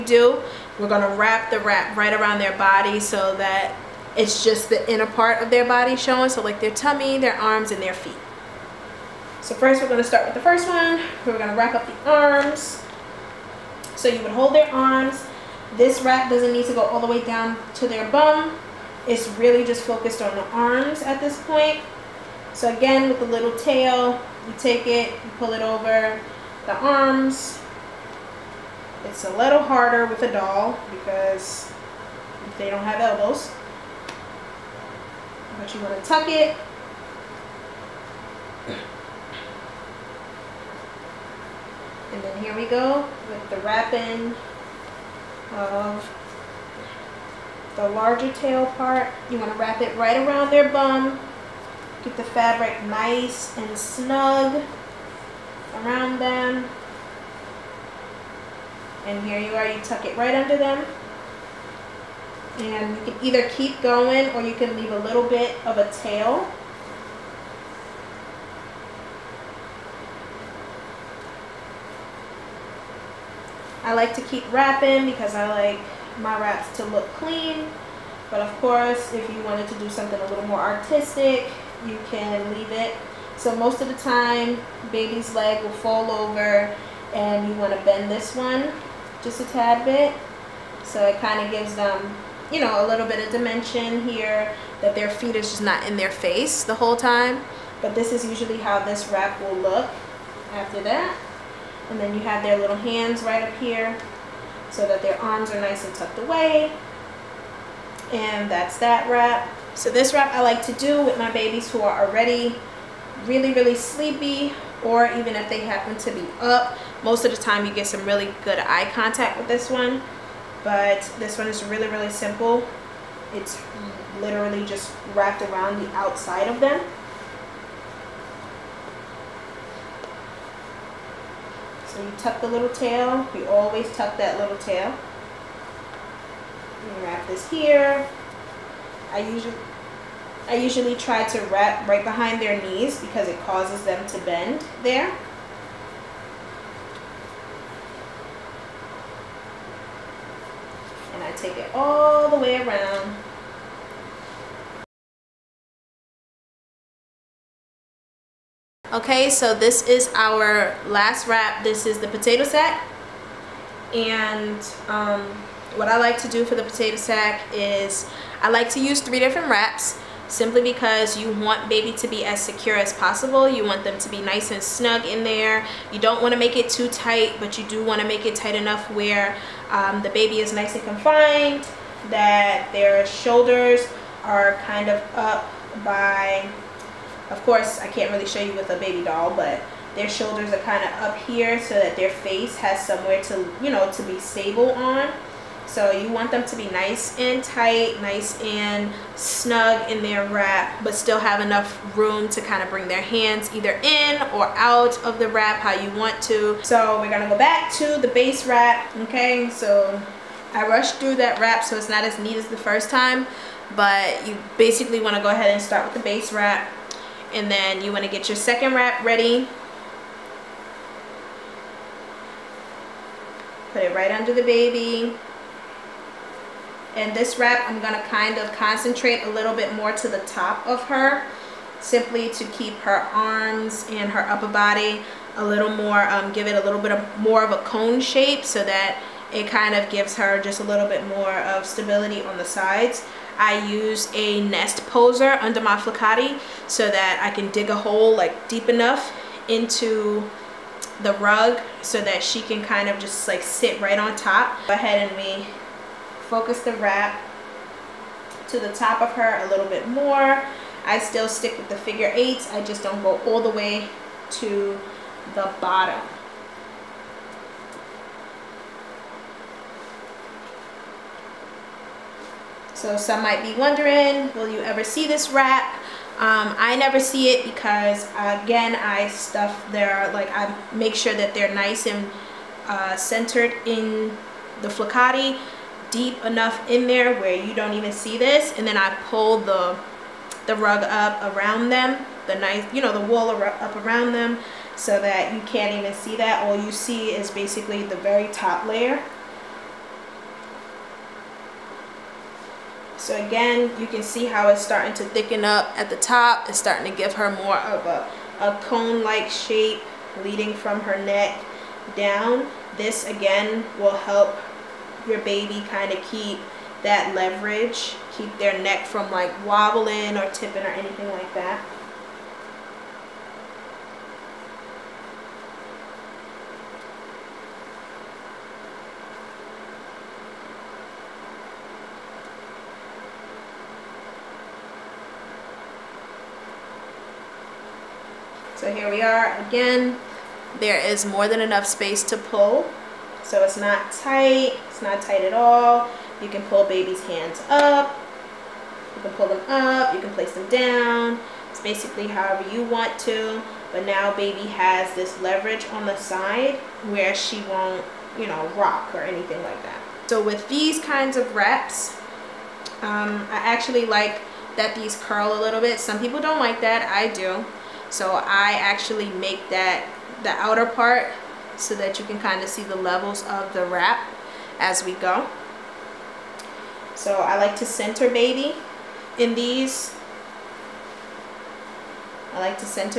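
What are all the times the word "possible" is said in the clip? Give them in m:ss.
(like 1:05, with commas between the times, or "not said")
2:52.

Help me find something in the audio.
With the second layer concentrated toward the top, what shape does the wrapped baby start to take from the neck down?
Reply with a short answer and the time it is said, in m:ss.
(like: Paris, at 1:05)
A cone shape, at 5:08.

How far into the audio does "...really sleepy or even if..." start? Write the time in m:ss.
1:53.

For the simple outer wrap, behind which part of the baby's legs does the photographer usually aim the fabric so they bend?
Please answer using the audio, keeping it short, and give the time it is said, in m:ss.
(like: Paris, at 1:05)
Behind their knees, at 2:21.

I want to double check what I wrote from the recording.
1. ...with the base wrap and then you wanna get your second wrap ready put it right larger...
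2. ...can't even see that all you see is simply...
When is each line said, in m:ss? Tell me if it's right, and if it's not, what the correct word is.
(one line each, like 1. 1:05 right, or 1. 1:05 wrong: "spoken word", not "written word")
1. 3:35 wrong: "under", not "larger"
2. 4:55 wrong: "basically", not "simply".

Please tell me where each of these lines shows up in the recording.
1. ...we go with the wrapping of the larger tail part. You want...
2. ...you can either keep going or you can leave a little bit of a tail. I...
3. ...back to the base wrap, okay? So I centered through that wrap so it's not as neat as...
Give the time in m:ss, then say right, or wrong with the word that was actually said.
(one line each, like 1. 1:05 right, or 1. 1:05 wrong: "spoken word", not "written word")
1. 0:42 right
2. 1:02 right
3. 3:27 wrong: "rushed", not "centered".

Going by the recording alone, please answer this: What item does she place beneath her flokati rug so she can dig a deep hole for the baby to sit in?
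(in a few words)
A nest poser.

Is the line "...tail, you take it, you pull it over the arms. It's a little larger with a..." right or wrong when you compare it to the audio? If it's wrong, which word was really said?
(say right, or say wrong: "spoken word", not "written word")
wrong: "harder", not "larger".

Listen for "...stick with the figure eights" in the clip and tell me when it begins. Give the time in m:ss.
4:21.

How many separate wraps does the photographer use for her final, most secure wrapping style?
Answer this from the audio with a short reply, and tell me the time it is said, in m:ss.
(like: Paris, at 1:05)
3, at 2:48.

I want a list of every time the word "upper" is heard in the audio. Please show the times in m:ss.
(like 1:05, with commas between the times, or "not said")
3:54.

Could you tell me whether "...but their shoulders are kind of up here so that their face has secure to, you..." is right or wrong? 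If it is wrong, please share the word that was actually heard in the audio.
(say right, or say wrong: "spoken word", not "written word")
wrong: "somewhere", not "secure".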